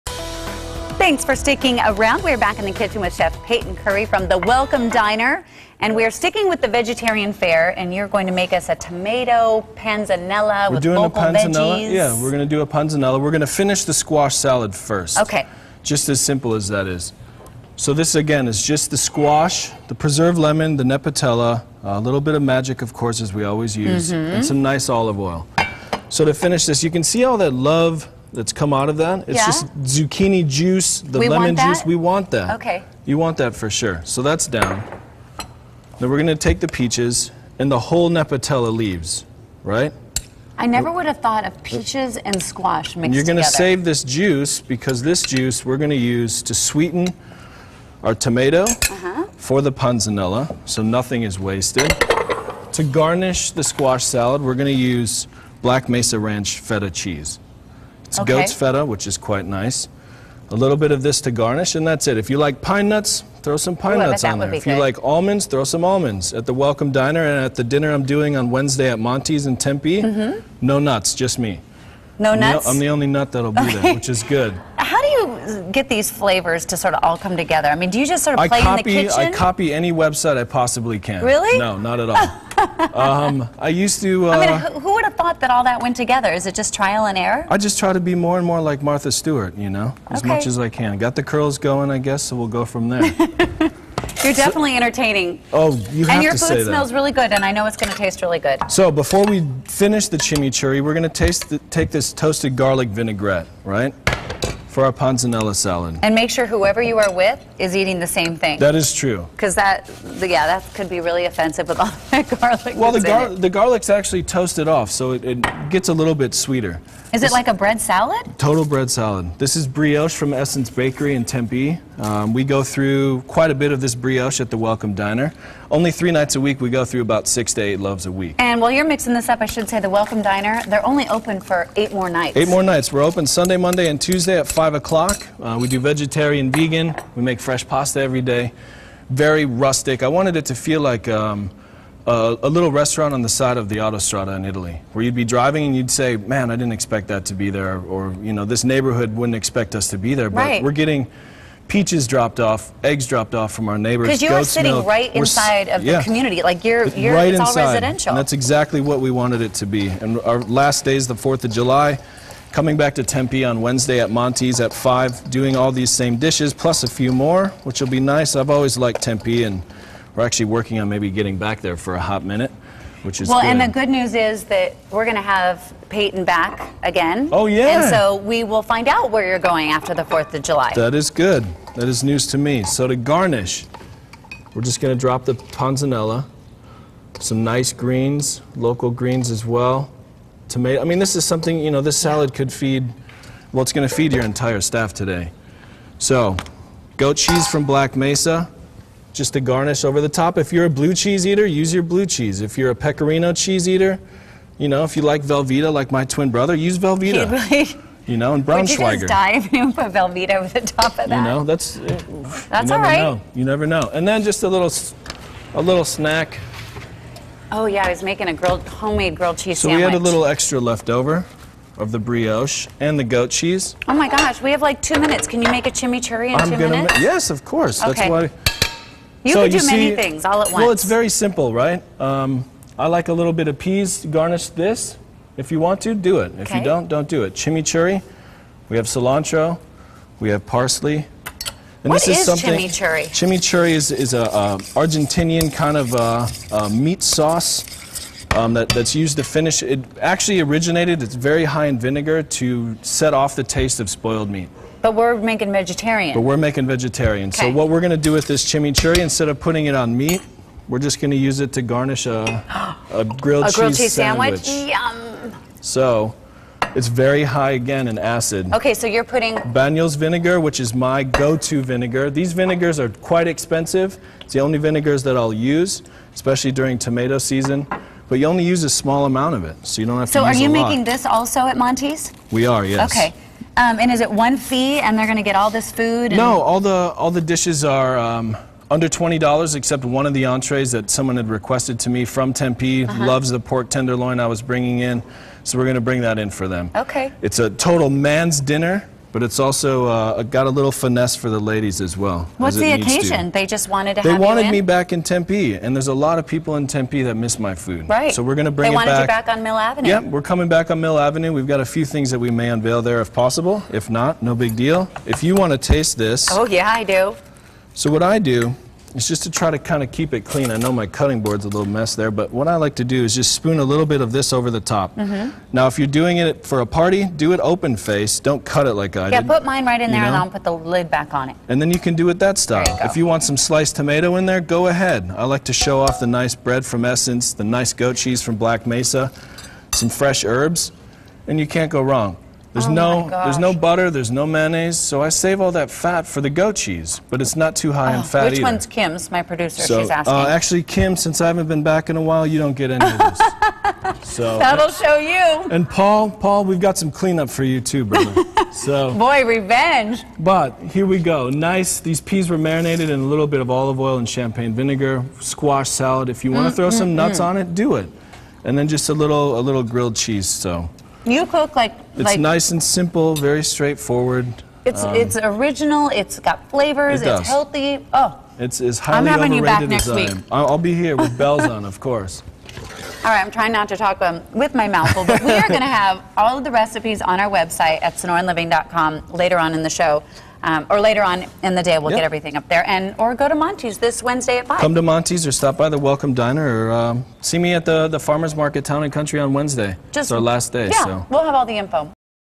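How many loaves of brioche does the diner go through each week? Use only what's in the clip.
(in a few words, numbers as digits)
6 to 8.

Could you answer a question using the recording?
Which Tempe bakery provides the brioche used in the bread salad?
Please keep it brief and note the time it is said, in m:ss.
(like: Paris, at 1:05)
Essence Bakery, at 2:00.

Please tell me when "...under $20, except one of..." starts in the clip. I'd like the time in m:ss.
4:48.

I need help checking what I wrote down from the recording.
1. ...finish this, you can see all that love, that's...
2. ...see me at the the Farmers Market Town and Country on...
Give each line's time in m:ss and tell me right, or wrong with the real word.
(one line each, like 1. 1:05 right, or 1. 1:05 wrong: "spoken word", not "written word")
1. 0:26 right
2. 6:37 right.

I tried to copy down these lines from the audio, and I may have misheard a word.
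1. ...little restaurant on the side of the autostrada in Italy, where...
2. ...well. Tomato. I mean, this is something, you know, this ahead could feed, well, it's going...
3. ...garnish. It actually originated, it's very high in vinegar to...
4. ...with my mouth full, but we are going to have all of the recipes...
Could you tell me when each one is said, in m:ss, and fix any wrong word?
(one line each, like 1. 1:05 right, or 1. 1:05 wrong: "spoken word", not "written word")
1. 2:22 right
2. 3:09 wrong: "salad", not "ahead"
3. 4:09 wrong: "finish", not "garnish"
4. 6:24 right.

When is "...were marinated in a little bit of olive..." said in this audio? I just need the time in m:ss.
6:02.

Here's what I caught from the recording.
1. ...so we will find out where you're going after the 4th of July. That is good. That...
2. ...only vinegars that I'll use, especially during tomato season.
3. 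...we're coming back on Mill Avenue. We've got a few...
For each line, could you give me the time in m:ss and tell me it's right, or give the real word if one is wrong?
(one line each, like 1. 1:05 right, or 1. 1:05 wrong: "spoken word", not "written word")
1. 2:57 right
2. 4:34 right
3. 5:10 right.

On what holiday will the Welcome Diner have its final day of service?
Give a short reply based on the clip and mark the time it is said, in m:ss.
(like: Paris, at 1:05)
Fourth of July, at 2:41.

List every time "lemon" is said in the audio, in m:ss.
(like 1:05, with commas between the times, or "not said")
0:20, 0:31.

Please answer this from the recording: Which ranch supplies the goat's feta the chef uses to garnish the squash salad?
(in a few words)
Black Mesa Ranch.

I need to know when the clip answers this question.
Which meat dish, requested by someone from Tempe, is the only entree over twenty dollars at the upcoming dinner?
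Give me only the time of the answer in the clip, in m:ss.
4:53.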